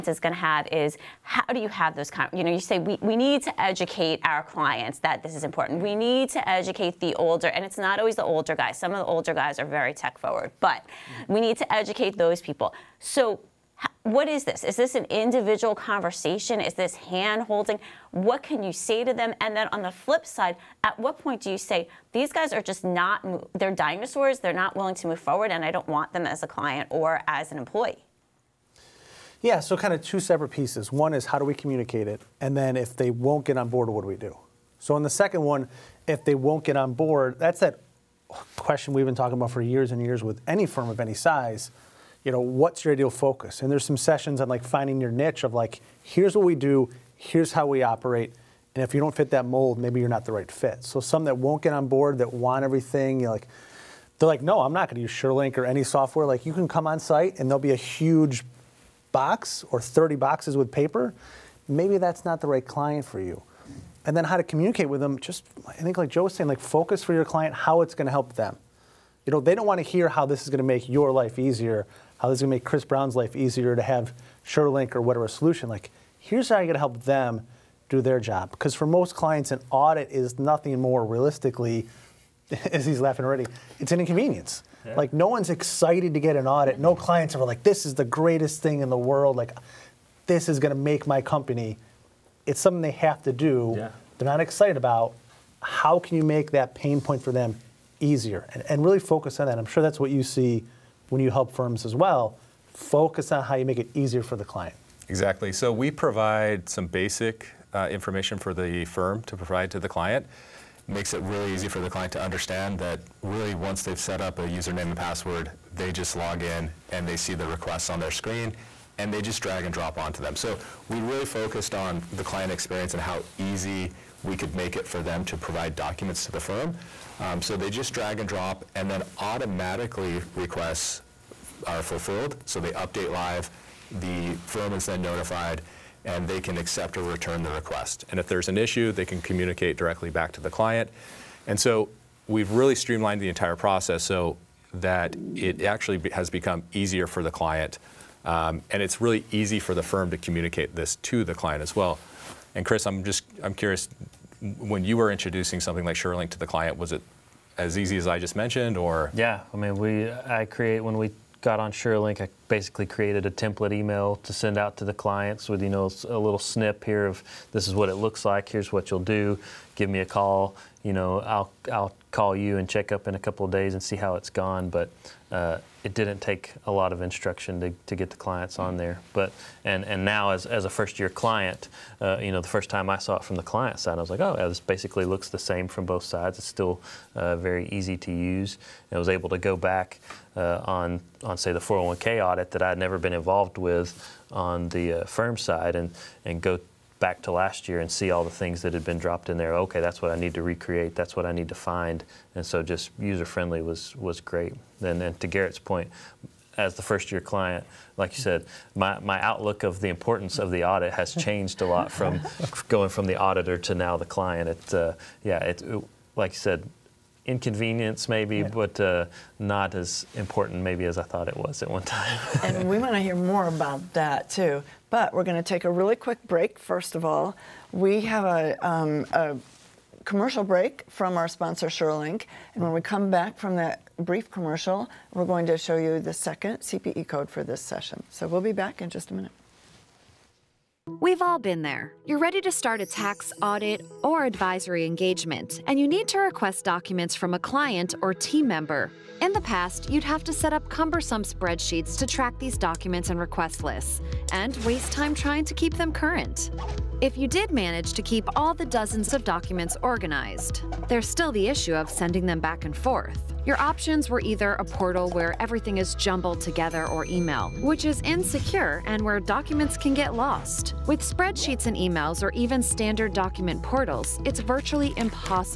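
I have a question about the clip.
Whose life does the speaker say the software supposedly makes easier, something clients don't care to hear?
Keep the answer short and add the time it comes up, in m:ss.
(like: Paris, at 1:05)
Chris Brown, at 1:12.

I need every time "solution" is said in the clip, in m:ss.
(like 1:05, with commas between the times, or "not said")
1:15.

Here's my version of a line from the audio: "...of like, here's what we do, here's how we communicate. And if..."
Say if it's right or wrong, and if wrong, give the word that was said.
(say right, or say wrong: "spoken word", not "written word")
wrong: "operate", not "communicate".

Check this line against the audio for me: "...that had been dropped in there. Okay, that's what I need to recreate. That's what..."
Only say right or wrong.
right.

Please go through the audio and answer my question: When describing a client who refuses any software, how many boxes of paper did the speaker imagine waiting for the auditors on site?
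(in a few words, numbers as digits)
30.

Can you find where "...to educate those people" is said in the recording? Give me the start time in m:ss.
0:11.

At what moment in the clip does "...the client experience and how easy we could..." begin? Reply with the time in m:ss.
2:02.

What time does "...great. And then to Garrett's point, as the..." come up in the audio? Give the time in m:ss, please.
3:24.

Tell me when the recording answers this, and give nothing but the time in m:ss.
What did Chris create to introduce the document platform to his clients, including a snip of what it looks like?
2:43.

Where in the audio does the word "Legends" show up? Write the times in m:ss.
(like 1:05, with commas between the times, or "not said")
not said.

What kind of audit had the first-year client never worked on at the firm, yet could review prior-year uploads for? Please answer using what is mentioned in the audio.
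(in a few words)
401k audit.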